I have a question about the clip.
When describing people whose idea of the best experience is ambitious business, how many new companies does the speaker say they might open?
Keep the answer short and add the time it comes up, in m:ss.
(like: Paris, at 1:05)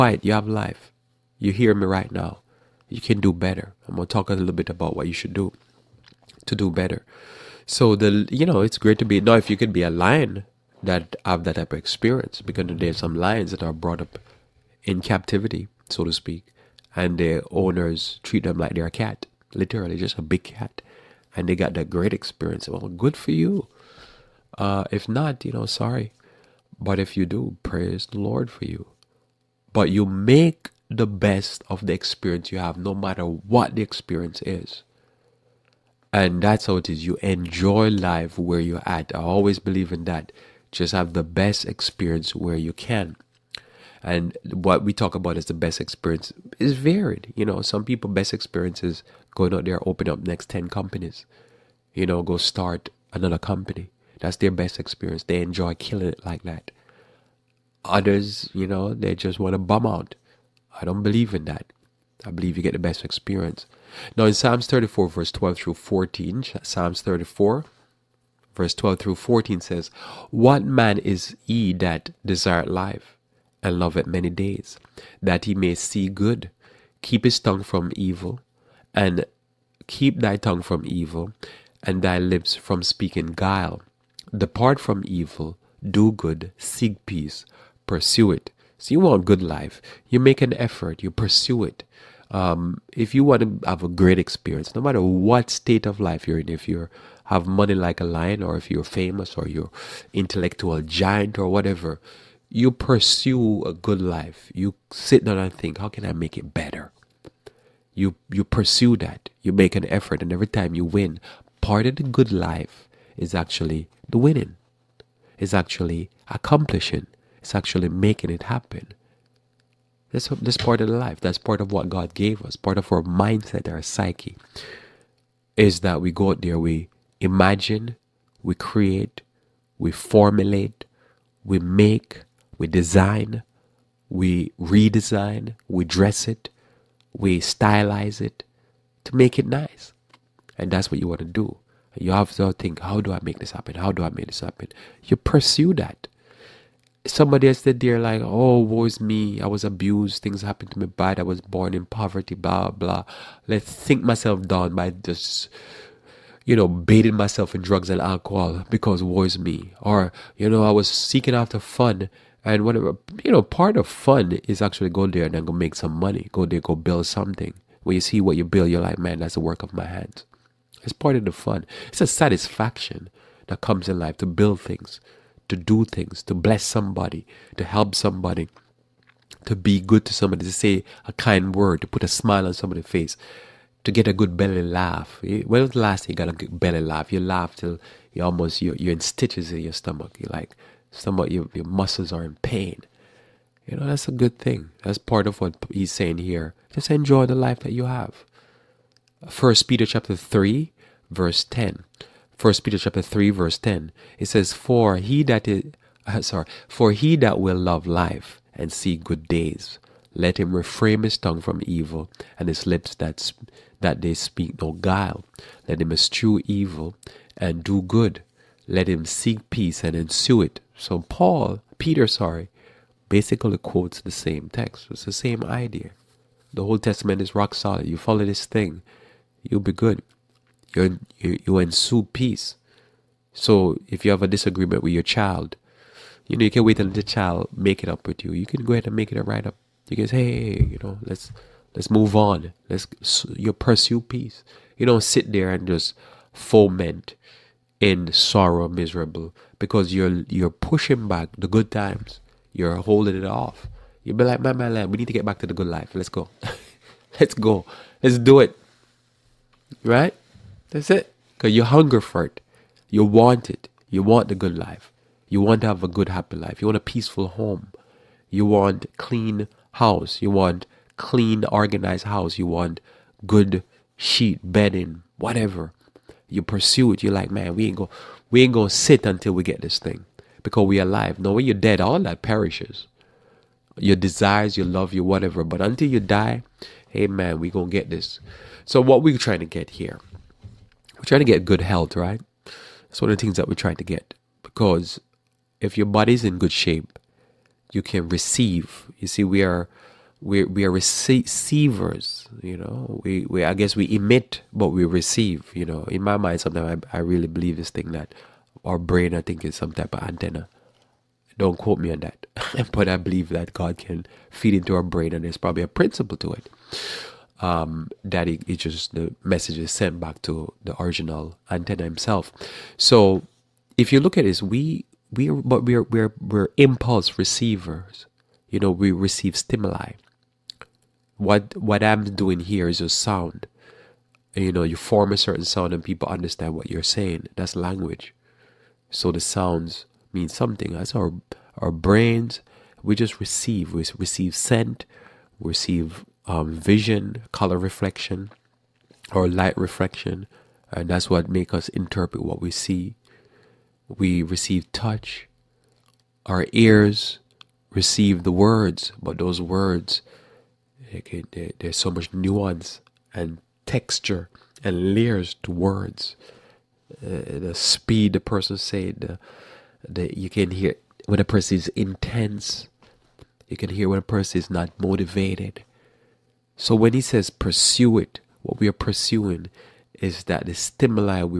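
10, at 0:50.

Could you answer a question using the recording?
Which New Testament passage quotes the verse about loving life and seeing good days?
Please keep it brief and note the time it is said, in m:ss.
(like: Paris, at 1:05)
First Peter chapter 3, at 3:19.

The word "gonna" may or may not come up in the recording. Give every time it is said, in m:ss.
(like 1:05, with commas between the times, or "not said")
0:03, 4:38, 4:47.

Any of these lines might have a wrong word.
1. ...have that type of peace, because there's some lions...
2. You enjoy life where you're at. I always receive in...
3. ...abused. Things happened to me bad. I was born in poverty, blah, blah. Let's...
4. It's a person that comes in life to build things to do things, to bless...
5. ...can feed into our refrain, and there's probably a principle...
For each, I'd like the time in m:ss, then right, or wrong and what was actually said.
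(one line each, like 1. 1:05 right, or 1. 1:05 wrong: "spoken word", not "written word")
1. 0:11 wrong: "experience", not "peace"
2. 0:37 wrong: "believe", not "receive"
3. 2:29 right
4. 2:51 wrong: "satisfaction", not "person"
5. 5:13 wrong: "brain", not "refrain".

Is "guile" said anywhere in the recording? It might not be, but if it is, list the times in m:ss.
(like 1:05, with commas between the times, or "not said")
1:23, 3:34.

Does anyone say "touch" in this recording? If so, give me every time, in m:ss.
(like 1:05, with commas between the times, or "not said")
5:54.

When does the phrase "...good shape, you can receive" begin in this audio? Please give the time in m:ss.
4:56.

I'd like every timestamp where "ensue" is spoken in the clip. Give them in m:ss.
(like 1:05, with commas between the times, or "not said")
3:39, 3:51.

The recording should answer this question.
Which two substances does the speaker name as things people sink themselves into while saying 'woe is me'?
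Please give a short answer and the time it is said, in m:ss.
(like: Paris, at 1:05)
Drugs and alcohol, at 2:37.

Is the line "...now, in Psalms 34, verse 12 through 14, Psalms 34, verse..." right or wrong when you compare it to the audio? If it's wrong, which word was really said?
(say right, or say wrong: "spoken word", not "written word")
right.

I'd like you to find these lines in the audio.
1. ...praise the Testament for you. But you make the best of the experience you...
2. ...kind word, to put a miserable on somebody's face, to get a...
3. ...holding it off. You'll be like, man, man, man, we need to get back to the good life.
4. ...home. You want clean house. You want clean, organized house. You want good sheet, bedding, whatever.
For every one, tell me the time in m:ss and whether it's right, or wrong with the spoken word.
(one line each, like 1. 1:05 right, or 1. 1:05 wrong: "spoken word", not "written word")
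1. 0:27 wrong: "Lord", not "Testament"
2. 3:01 wrong: "smile", not "miserable"
3. 4:12 right
4. 4:27 right.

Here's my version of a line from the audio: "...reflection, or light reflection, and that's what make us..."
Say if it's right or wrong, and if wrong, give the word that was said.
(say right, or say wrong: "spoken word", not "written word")
right.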